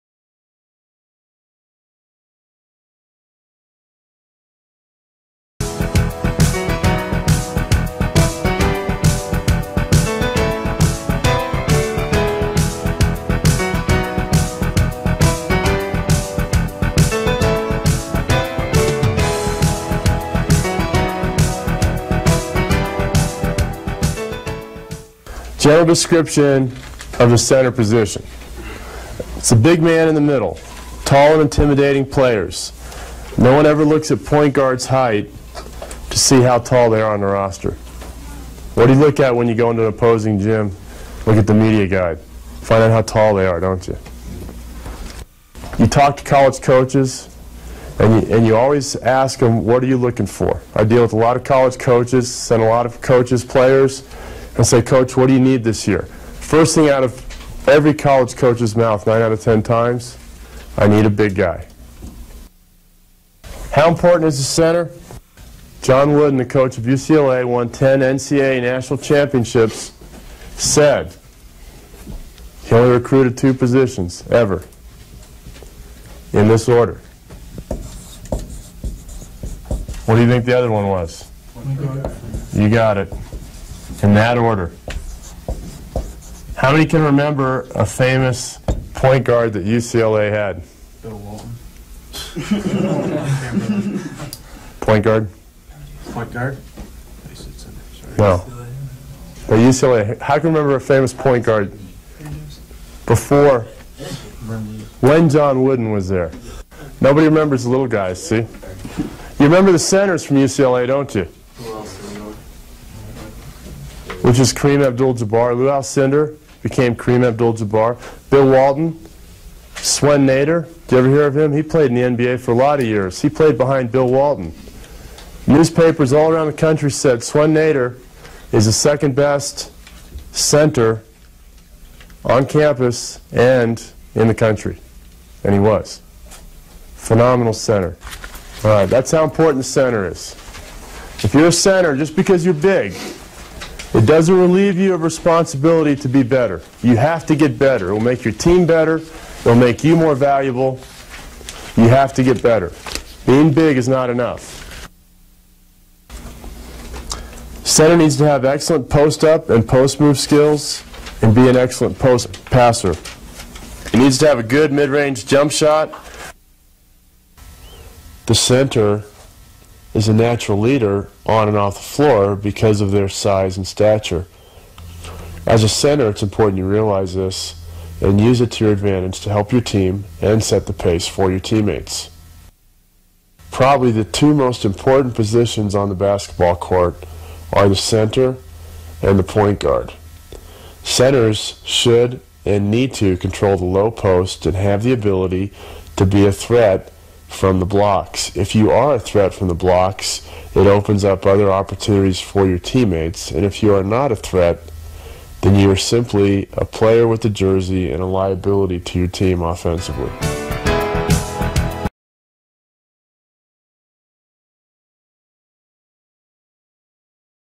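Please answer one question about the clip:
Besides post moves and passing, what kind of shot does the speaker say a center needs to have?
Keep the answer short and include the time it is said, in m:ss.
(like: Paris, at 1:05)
mid-range jump shot, at 2:44.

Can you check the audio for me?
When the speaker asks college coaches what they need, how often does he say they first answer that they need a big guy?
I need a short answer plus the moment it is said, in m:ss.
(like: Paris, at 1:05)
9 out of 10 times, at 0:59.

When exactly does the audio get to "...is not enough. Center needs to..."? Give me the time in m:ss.
2:33.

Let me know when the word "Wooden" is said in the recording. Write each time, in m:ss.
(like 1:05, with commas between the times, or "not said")
1:06, 1:45.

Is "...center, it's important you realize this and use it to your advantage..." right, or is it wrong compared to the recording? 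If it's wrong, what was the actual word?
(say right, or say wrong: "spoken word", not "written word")
right.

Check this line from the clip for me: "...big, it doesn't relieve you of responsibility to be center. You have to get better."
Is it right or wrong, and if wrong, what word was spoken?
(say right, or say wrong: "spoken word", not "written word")
wrong: "better", not "center".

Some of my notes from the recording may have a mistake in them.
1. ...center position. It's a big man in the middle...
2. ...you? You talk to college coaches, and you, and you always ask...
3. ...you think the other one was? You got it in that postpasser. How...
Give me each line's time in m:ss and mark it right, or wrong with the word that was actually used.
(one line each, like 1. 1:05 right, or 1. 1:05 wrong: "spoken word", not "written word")
1. 0:27 right
2. 0:43 right
3. 1:20 wrong: "order", not "postpasser".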